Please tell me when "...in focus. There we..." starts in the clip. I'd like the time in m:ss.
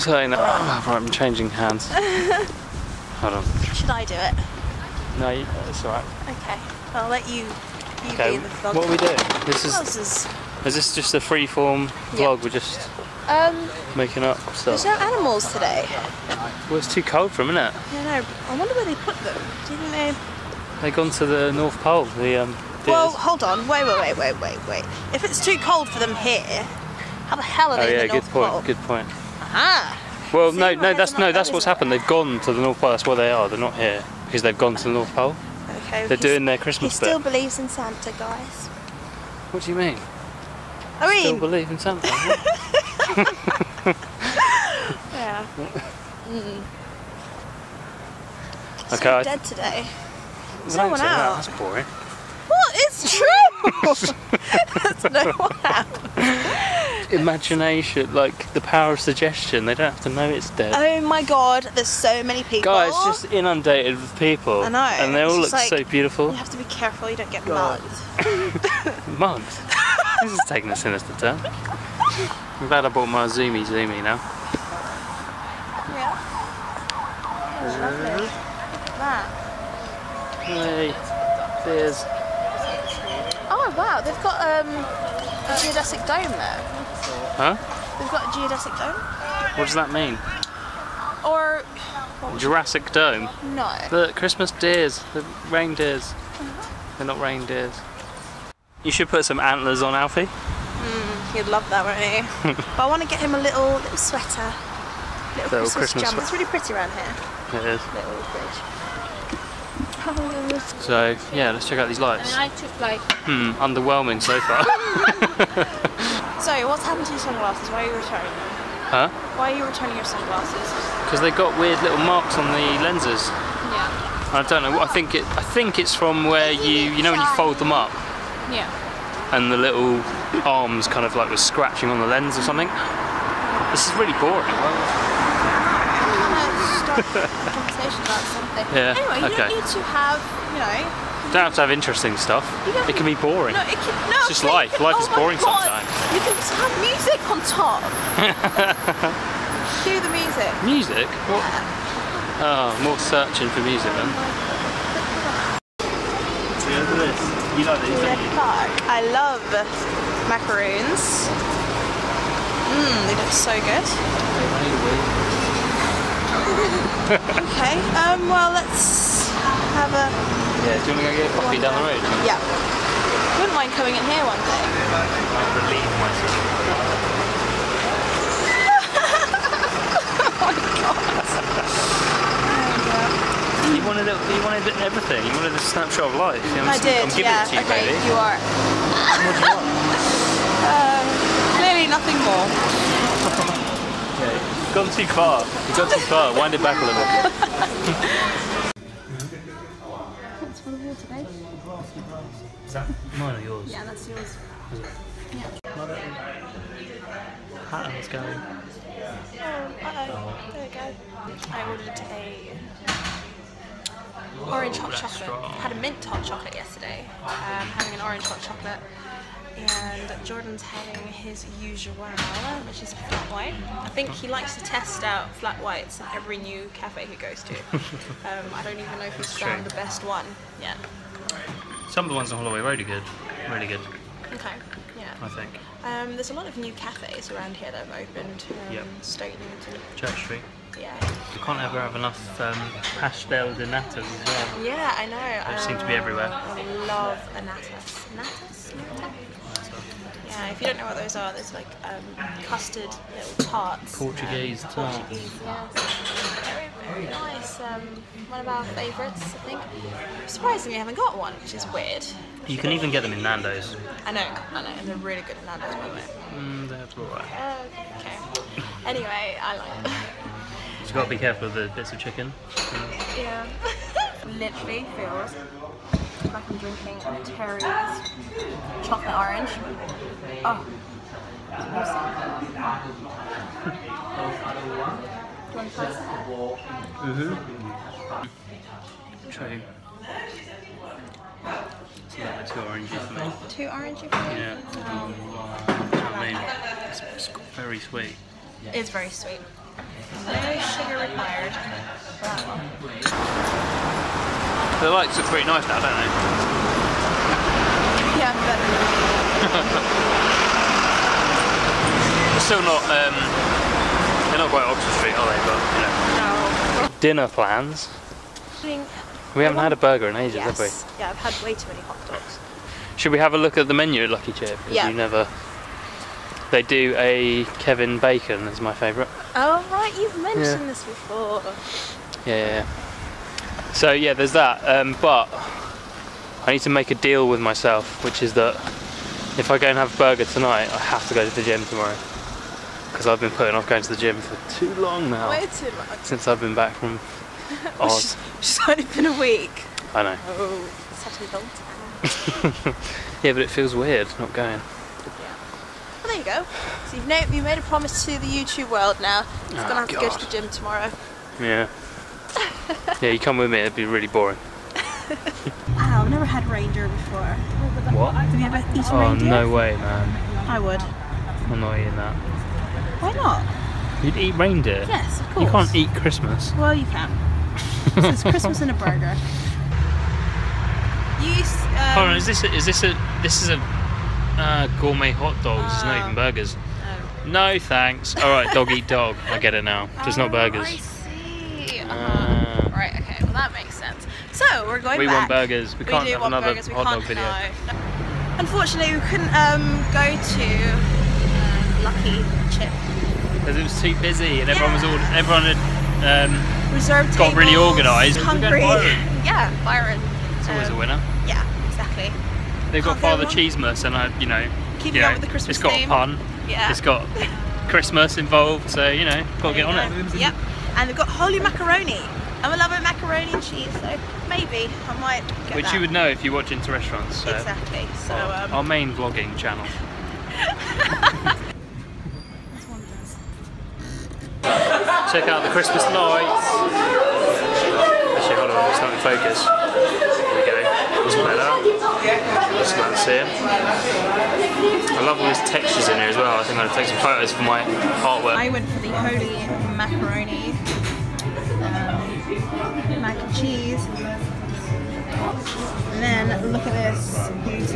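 7:18.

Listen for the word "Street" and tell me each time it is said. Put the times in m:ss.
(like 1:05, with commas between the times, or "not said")
4:00, 5:15.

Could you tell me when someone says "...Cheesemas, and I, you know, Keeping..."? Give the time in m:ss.
6:53.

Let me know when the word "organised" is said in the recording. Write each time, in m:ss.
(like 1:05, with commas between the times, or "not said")
6:47.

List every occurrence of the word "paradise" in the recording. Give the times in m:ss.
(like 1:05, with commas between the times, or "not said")
not said.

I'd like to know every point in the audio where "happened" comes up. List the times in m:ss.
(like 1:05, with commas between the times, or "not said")
0:31, 1:56.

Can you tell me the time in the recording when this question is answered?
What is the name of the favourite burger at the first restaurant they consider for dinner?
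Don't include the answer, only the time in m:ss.
5:27.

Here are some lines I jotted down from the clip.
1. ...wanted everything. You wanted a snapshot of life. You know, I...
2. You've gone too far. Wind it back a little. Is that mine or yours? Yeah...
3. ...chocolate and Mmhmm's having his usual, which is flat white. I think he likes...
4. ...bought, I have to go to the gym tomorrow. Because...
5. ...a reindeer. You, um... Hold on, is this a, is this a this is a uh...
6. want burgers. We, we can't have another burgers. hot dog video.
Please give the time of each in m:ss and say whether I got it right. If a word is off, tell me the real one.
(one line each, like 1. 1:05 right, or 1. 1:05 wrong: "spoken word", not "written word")
1. 3:04 right
2. 3:15 right
3. 3:38 wrong: "Jordan", not "Mmhmm"
4. 5:40 wrong: "tonight", not "bought"
5. 6:18 wrong: "burger", not "reindeer"
6. 6:35 right.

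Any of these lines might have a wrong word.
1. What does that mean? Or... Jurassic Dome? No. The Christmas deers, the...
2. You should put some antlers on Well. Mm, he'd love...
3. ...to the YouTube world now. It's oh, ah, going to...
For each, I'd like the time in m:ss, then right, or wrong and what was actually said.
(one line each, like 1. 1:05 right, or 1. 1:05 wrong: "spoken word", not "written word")
1. 1:29 right
2. 1:38 wrong: "Alfie", not "Well"
3. 5:58 right.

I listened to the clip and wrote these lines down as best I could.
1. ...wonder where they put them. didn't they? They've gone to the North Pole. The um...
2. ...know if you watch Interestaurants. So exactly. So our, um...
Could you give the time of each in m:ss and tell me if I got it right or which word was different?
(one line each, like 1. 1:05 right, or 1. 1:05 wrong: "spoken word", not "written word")
1. 0:18 right
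2. 7:05 right.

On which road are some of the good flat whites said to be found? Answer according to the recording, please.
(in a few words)
Holloway Road.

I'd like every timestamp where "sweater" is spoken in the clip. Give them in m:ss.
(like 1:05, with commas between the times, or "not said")
1:43.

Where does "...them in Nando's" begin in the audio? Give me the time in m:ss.
4:23.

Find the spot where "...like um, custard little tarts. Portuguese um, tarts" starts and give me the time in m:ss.
4:11.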